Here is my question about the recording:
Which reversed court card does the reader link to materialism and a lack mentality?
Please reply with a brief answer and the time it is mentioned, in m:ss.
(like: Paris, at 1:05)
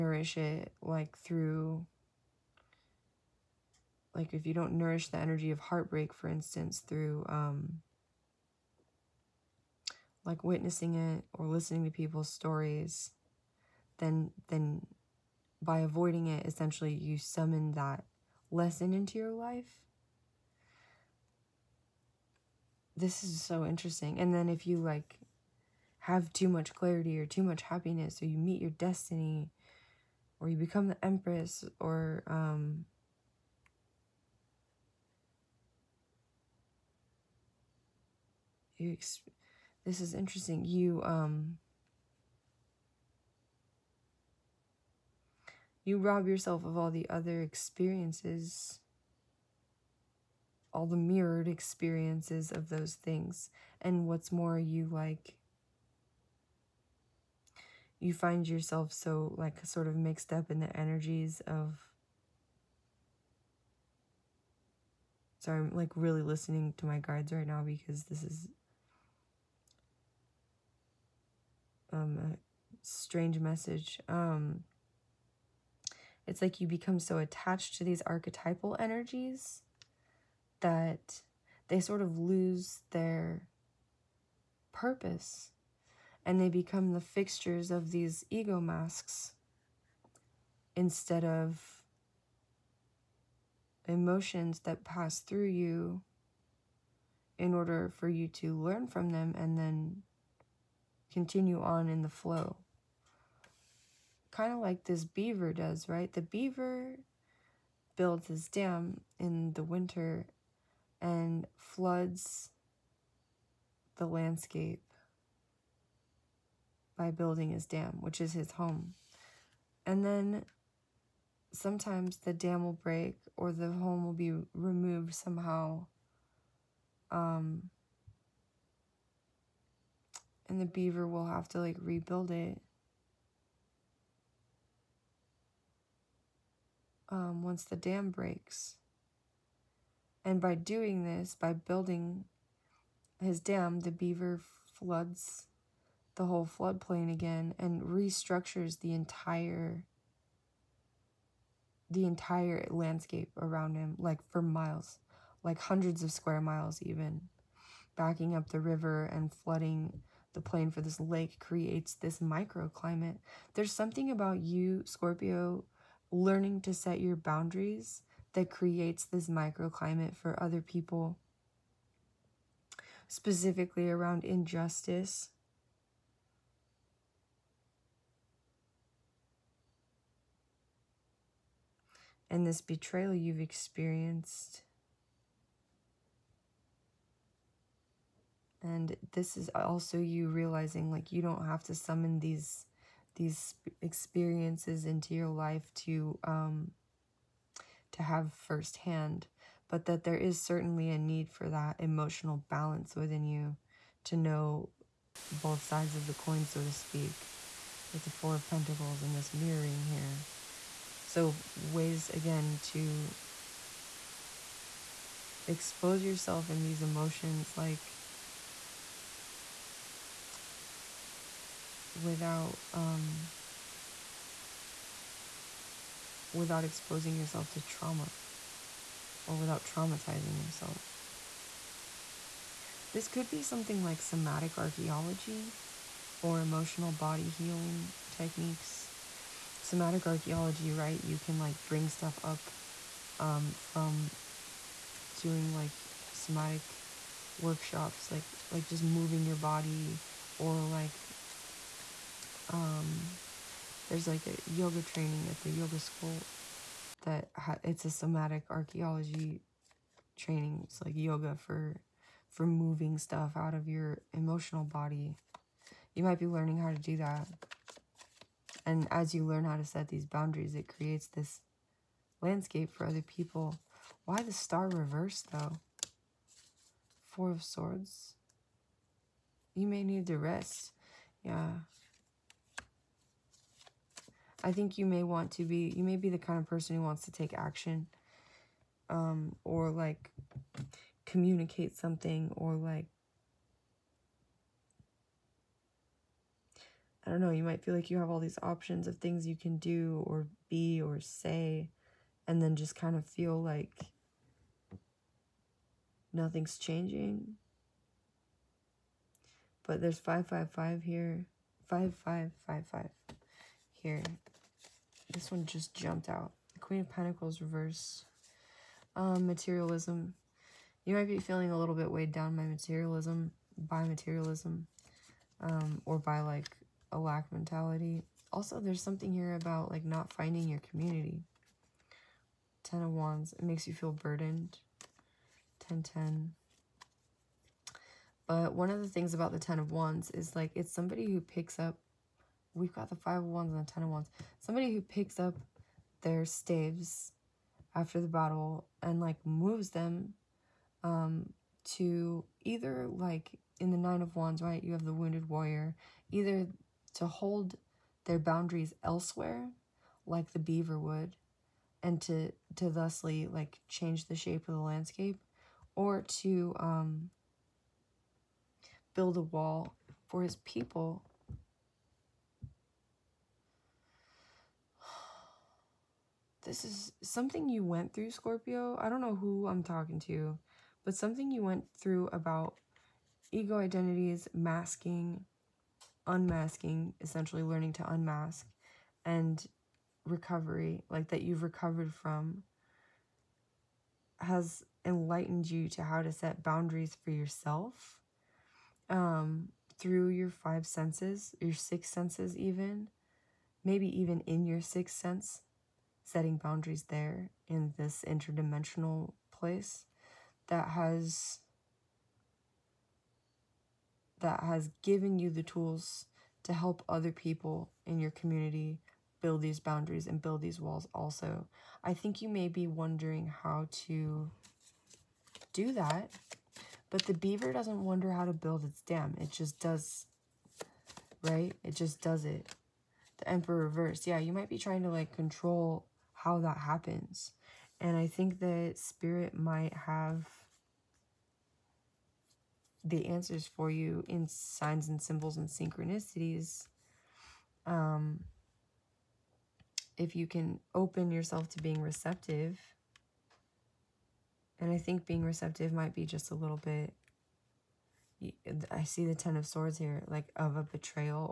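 Queen of Pentacles, at 5:16.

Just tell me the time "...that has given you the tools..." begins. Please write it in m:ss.
6:54.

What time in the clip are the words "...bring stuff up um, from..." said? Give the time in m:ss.
4:01.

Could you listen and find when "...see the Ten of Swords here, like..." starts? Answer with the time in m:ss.
7:38.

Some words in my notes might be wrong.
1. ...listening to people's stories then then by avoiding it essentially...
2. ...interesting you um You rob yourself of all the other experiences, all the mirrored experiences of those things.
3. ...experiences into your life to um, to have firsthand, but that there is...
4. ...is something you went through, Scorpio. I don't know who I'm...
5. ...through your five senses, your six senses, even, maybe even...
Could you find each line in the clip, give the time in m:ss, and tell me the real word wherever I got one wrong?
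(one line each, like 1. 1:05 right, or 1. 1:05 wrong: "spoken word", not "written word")
1. 0:11 right
2. 0:40 right
3. 3:13 right
4. 6:16 right
5. 6:39 right.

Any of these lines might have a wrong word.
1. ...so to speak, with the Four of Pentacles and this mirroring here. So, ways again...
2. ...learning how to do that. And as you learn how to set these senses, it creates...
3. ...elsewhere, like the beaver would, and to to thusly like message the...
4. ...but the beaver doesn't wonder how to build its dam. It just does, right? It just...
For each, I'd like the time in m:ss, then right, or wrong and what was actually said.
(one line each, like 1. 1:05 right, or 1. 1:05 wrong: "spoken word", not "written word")
1. 3:26 right
2. 4:26 wrong: "boundaries", not "senses"
3. 5:58 wrong: "change", not "message"
4. 7:06 right.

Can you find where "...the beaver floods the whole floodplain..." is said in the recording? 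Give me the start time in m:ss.
2:23.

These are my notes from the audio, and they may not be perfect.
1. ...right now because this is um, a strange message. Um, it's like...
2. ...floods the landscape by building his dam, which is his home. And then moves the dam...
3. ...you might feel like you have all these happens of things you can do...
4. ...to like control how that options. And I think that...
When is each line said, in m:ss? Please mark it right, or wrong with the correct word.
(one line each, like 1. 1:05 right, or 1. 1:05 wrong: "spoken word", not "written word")
1. 1:07 right
2. 1:51 wrong: "sometimes", not "moves"
3. 4:57 wrong: "options", not "happens"
4. 7:14 wrong: "happens", not "options".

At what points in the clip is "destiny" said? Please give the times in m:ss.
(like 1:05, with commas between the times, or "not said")
0:28.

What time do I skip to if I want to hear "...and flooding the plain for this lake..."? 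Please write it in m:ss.
2:39.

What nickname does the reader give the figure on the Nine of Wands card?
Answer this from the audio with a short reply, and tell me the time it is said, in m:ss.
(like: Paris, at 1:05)
Wounded Warrior, at 5:54.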